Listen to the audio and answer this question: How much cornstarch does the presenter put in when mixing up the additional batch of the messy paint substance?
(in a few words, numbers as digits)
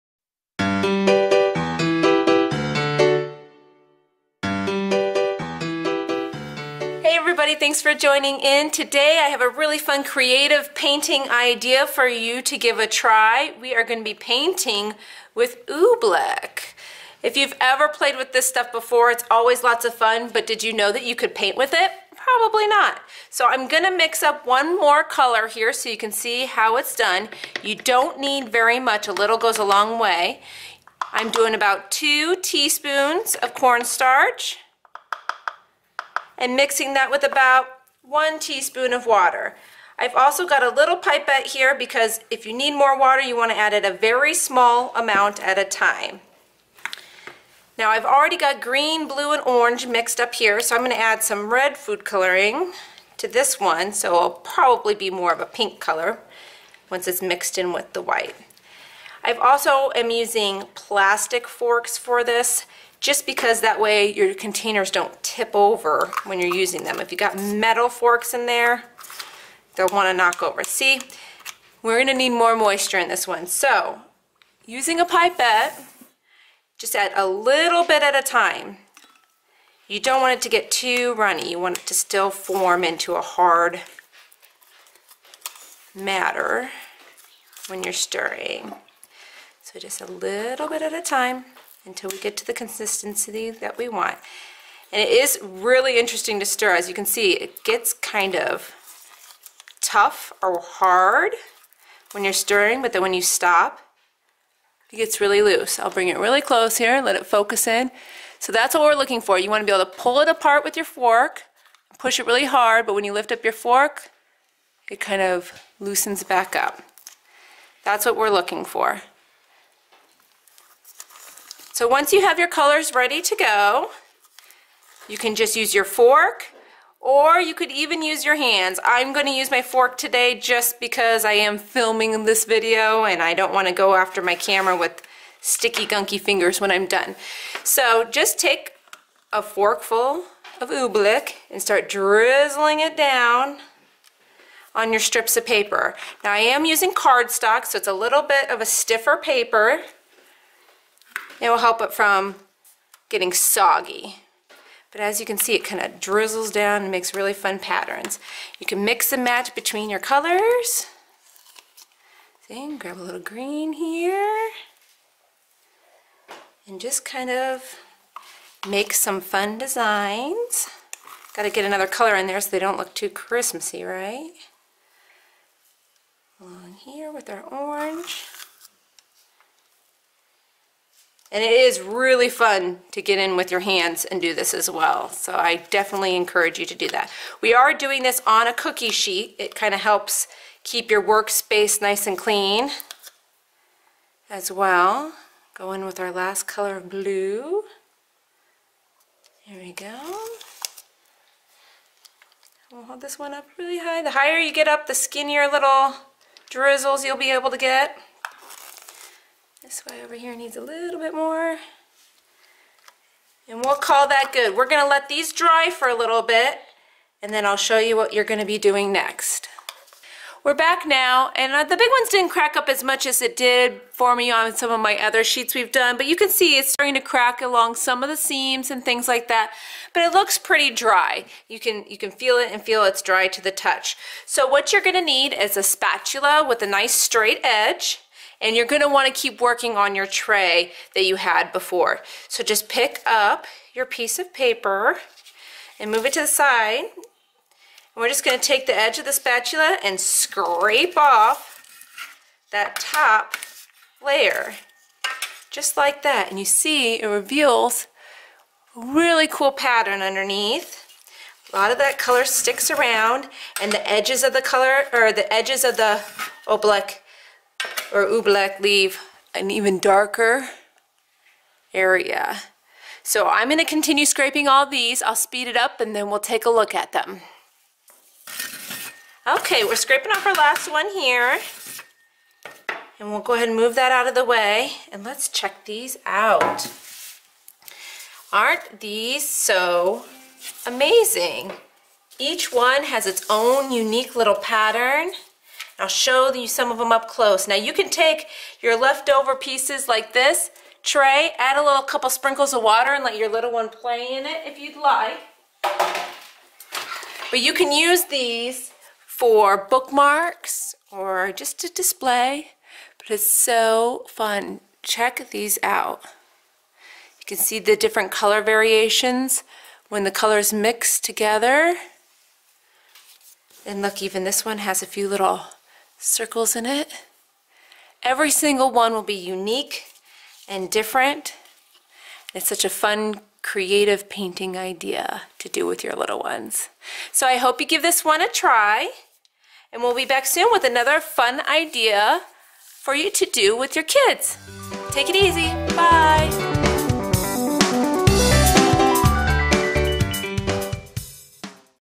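2 teaspoons.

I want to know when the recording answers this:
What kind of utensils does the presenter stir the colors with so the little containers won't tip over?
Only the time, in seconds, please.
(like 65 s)
60 s.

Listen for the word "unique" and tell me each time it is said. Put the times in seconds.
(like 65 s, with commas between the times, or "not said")
293 s, 329 s.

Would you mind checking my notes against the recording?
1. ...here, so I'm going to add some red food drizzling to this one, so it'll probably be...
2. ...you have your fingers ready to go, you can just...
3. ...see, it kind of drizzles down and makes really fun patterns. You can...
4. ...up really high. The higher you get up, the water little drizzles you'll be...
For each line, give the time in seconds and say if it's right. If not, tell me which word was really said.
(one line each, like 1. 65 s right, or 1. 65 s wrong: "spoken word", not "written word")
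1. 50 s wrong: "coloring", not "drizzling"
2. 122 s wrong: "colors", not "fingers"
3. 155 s right
4. 203 s wrong: "skinnier", not "water".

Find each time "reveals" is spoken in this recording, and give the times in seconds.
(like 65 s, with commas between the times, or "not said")
257 s.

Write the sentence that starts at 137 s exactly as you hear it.
So just take a forkful of oobleck and start drizzling it down on your strips of paper.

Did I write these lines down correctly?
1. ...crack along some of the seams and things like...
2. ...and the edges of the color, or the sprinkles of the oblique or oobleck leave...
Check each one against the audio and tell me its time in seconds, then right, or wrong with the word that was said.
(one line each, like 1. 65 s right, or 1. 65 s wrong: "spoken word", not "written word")
1. 226 s right
2. 263 s wrong: "edges", not "sprinkles".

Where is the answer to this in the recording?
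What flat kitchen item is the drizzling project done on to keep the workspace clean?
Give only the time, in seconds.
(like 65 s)
188 s.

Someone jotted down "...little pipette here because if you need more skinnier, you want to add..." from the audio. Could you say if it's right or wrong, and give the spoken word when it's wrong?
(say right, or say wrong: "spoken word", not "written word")
wrong: "water", not "skinnier".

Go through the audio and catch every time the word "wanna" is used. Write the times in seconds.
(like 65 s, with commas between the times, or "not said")
238 s.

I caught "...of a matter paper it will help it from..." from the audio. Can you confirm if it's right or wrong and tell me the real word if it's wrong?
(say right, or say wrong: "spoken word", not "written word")
wrong: "stiffer", not "matter".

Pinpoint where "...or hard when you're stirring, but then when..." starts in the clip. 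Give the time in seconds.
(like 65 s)
100 s.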